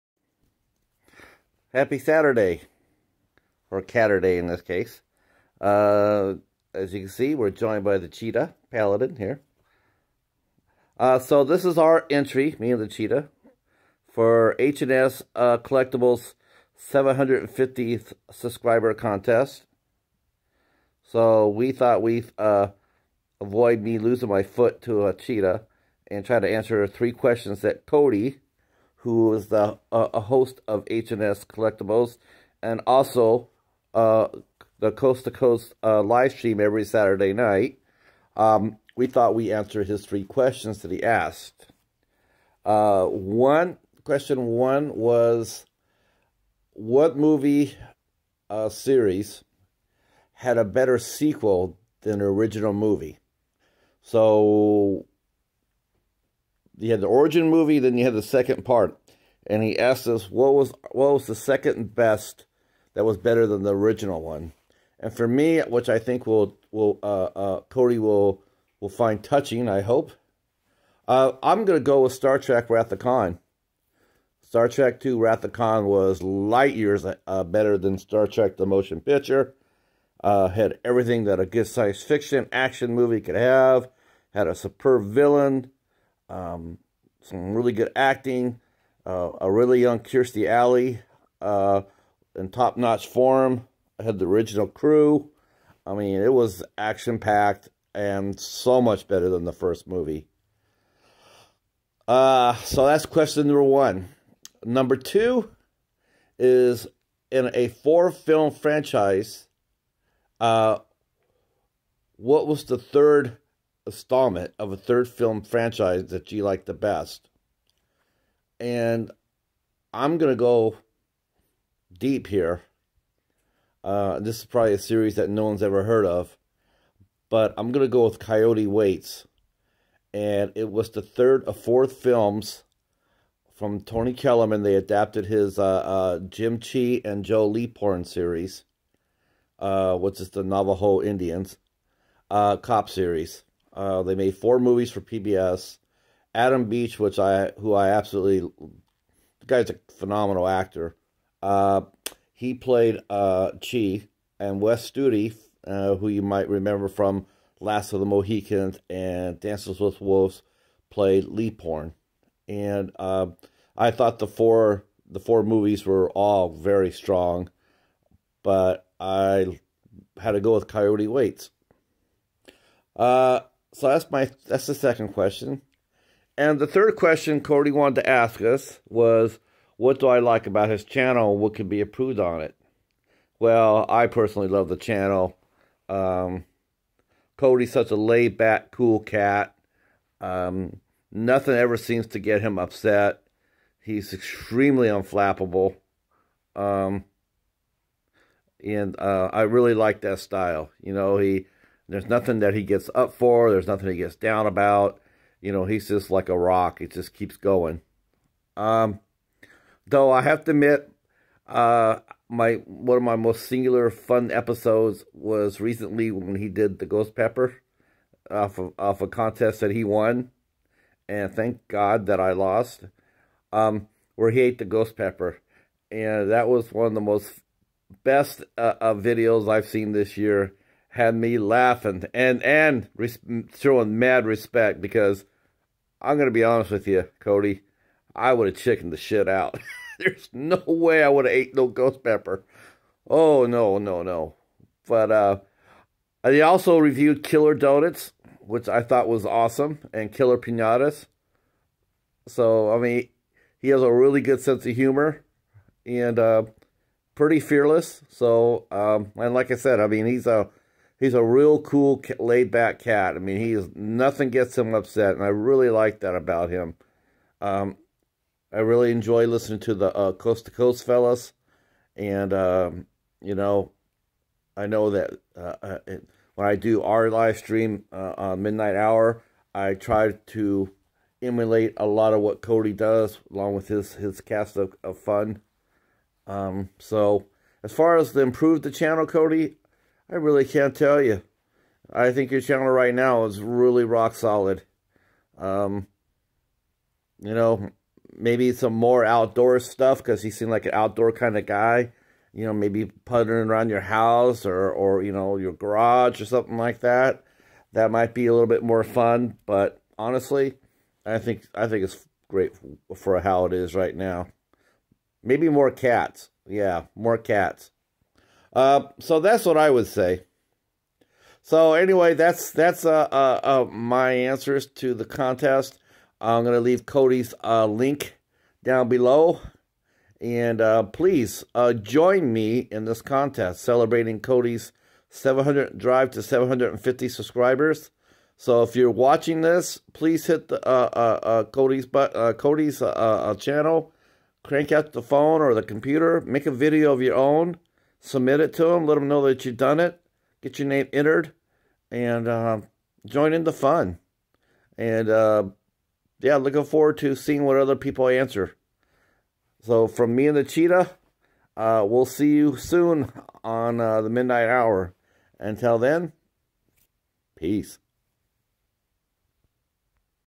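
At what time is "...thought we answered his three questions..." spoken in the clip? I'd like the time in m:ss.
0:39.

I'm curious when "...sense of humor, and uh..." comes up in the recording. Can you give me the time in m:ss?
4:14.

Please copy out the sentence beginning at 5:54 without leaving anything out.
And uh, yeah, looking forward to seeing what other people answer.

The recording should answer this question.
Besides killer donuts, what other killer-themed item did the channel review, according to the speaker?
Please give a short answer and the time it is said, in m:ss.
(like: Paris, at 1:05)
Killer Pinatas, at 4:10.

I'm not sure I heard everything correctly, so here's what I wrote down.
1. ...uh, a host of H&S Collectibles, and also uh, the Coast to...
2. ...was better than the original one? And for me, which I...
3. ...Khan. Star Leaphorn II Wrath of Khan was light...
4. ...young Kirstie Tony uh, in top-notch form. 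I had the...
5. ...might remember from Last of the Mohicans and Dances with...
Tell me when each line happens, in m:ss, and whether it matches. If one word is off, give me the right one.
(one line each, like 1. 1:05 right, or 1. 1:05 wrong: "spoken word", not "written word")
1. 0:29 right
2. 1:03 right
3. 1:12 wrong: "Trek", not "Leaphorn"
4. 1:29 wrong: "Alley", not "Tony"
5. 2:36 right.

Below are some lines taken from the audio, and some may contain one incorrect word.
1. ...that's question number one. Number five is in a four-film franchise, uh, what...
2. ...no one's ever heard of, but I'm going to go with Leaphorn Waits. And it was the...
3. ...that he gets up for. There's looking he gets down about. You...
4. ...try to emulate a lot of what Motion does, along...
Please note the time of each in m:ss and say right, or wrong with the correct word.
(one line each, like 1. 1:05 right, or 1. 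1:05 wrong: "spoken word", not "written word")
1. 1:42 wrong: "two", not "five"
2. 2:05 wrong: "Coyote", not "Leaphorn"
3. 3:22 wrong: "nothing", not "looking"
4. 4:39 wrong: "Cody", not "Motion".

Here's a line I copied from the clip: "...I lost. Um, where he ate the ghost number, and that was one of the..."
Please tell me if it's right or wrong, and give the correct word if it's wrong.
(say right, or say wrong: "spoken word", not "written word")
wrong: "pepper", not "number".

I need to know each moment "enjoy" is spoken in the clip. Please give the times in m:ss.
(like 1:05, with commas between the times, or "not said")
4:28.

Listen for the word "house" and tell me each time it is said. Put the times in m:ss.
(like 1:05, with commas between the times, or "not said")
5:03.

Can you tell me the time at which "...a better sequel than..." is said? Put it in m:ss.
0:50.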